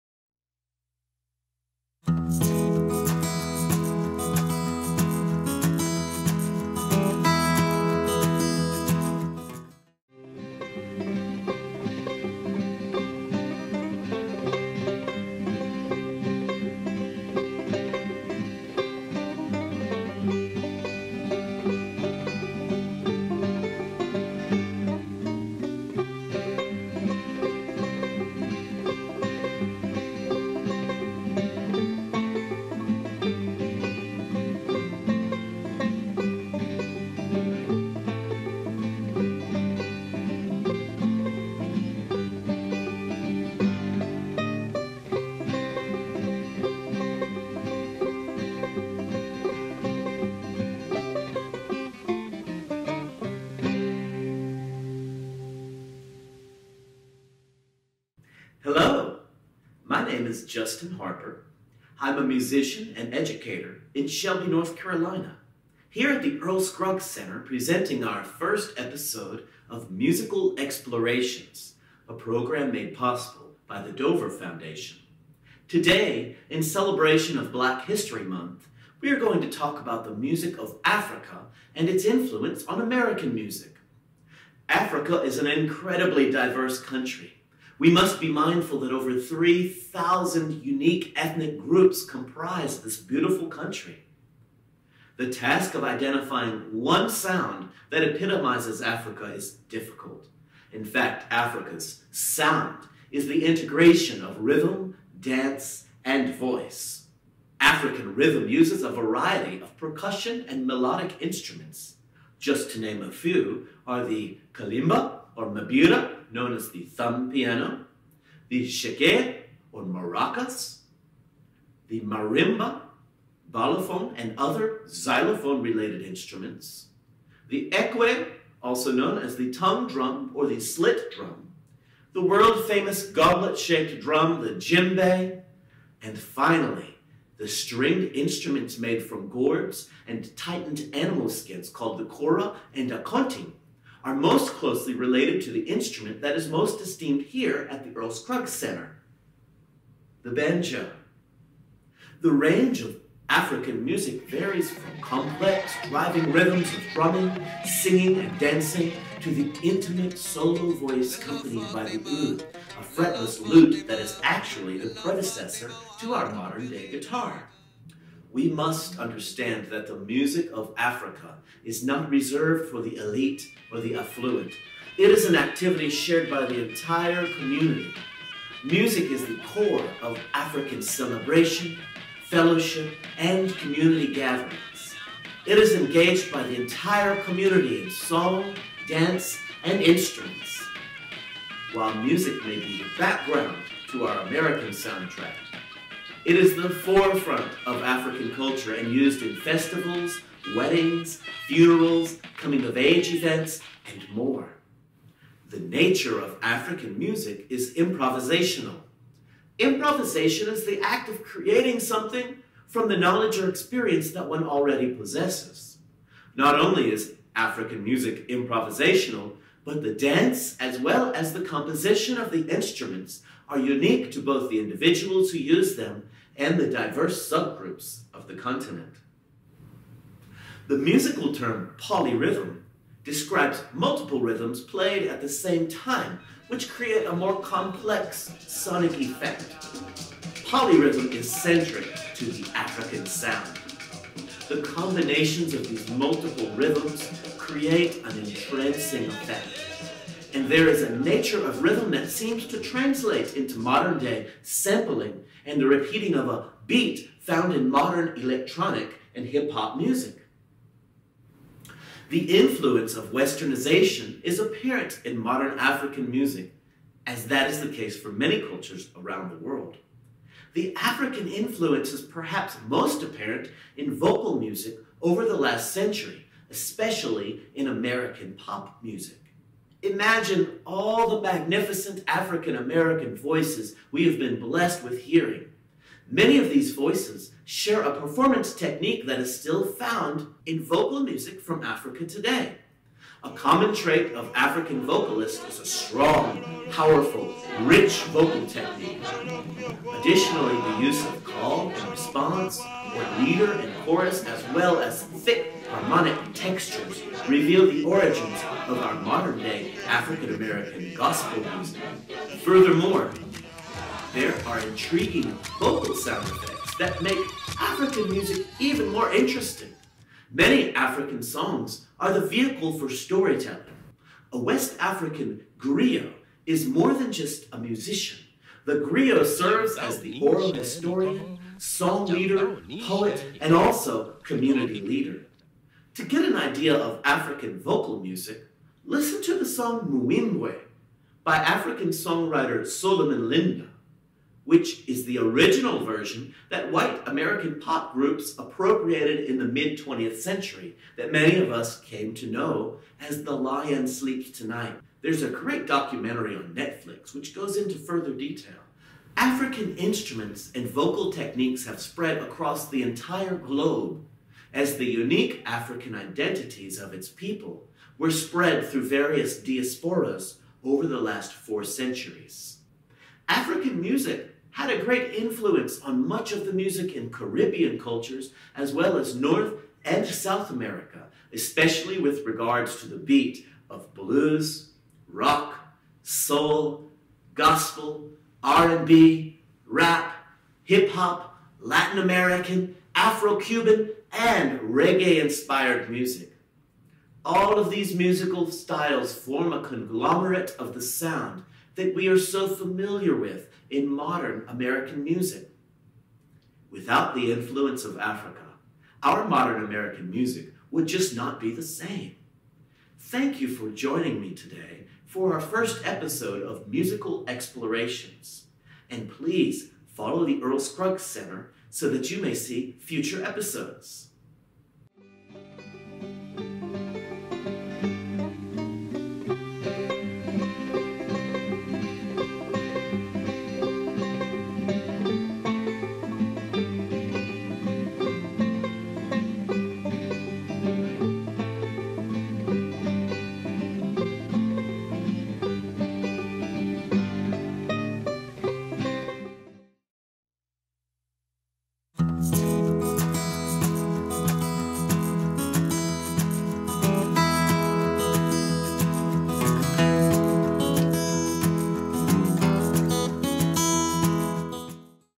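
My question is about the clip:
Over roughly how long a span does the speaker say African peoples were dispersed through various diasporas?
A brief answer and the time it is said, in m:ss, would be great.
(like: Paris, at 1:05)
4 centuries, at 6:11.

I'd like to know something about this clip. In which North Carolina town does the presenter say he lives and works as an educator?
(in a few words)
Shelby.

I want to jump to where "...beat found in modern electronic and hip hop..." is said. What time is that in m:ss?
4:16.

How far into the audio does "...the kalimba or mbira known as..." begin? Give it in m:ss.
1:54.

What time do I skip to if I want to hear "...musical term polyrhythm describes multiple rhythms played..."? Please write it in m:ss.
3:50.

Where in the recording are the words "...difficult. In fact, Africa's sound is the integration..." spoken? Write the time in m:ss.
1:39.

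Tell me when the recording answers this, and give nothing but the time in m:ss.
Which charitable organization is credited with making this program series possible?
1:13.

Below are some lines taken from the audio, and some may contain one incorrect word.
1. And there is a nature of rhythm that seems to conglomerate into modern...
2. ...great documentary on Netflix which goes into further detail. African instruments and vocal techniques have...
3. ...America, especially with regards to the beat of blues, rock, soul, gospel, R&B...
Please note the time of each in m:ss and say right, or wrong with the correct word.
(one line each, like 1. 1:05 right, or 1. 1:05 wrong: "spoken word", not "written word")
1. 4:10 wrong: "translate", not "conglomerate"
2. 5:55 right
3. 6:20 right.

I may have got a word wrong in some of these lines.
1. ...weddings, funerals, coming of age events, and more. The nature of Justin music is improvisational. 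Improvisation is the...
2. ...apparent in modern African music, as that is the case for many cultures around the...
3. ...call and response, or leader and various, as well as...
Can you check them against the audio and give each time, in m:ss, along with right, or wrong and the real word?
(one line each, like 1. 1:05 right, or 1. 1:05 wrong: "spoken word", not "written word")
1. 3:20 wrong: "African", not "Justin"
2. 4:24 right
3. 5:01 wrong: "chorus", not "various".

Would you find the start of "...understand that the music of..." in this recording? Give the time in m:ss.
2:48.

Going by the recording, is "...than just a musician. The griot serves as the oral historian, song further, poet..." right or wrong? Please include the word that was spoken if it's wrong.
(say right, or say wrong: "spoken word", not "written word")
wrong: "leader", not "further".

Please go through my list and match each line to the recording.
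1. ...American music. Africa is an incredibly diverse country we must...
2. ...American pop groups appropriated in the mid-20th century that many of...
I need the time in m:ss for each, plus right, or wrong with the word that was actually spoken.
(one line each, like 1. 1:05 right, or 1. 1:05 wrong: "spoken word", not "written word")
1. 1:22 right
2. 5:47 right.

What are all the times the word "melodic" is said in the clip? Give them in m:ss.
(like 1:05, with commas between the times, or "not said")
1:50.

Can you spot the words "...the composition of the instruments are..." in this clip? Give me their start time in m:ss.
3:41.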